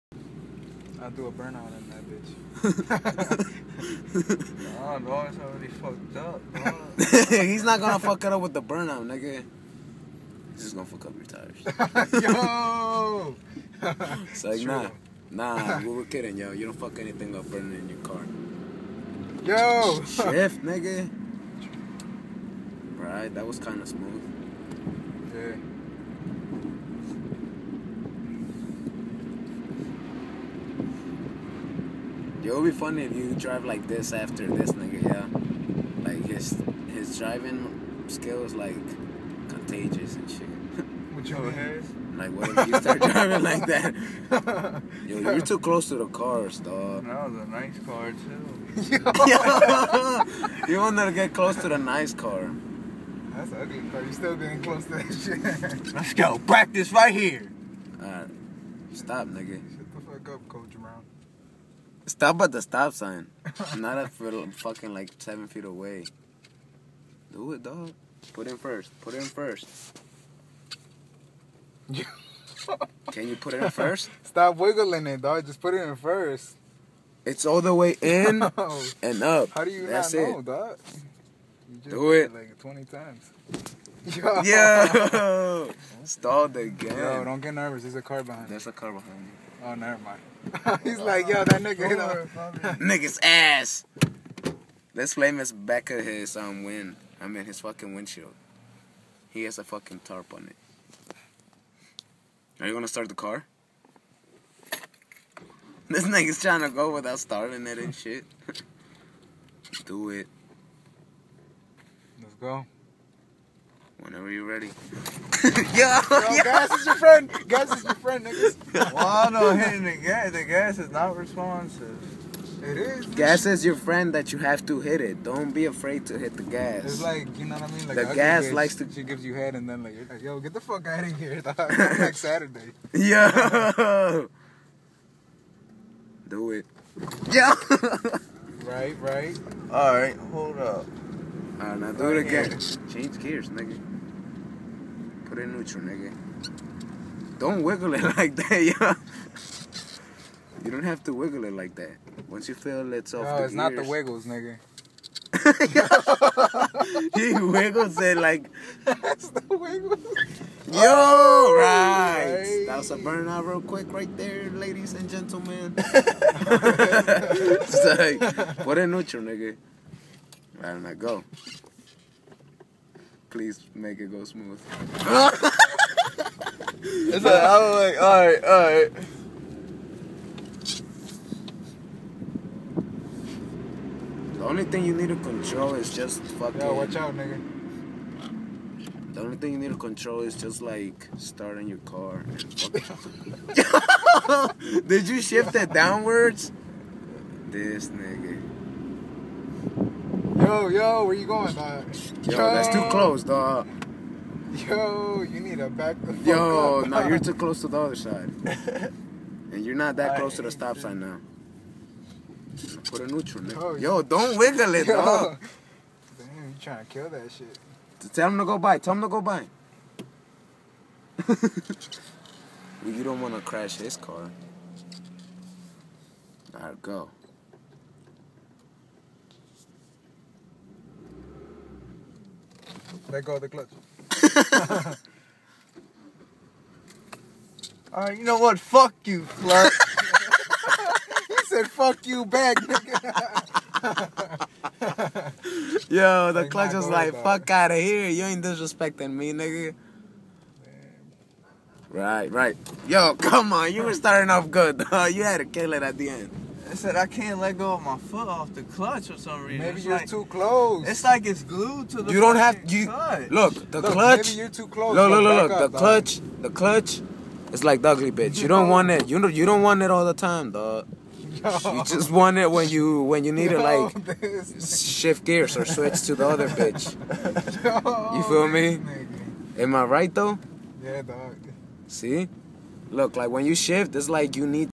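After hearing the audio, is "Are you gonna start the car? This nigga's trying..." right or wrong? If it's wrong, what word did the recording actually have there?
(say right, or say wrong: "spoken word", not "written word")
right.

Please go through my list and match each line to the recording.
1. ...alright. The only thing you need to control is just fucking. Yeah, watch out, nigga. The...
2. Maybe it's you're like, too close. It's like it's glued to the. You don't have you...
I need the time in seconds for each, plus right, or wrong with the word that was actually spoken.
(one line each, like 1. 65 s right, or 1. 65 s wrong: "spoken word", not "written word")
1. 178 s right
2. 259 s right.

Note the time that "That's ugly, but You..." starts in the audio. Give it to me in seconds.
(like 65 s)
53 s.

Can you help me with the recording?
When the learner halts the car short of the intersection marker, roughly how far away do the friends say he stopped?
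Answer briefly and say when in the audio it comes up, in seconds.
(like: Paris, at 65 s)
7 feet, at 65 s.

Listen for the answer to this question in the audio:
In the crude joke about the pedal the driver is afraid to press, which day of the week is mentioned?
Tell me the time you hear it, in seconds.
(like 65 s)
132 s.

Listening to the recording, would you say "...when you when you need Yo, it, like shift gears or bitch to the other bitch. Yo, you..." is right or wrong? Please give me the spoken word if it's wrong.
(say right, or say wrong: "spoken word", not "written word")
wrong: "switch", not "bitch".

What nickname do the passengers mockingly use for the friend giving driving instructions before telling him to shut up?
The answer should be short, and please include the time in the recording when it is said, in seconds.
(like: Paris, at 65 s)
Coach Brown, at 60 s.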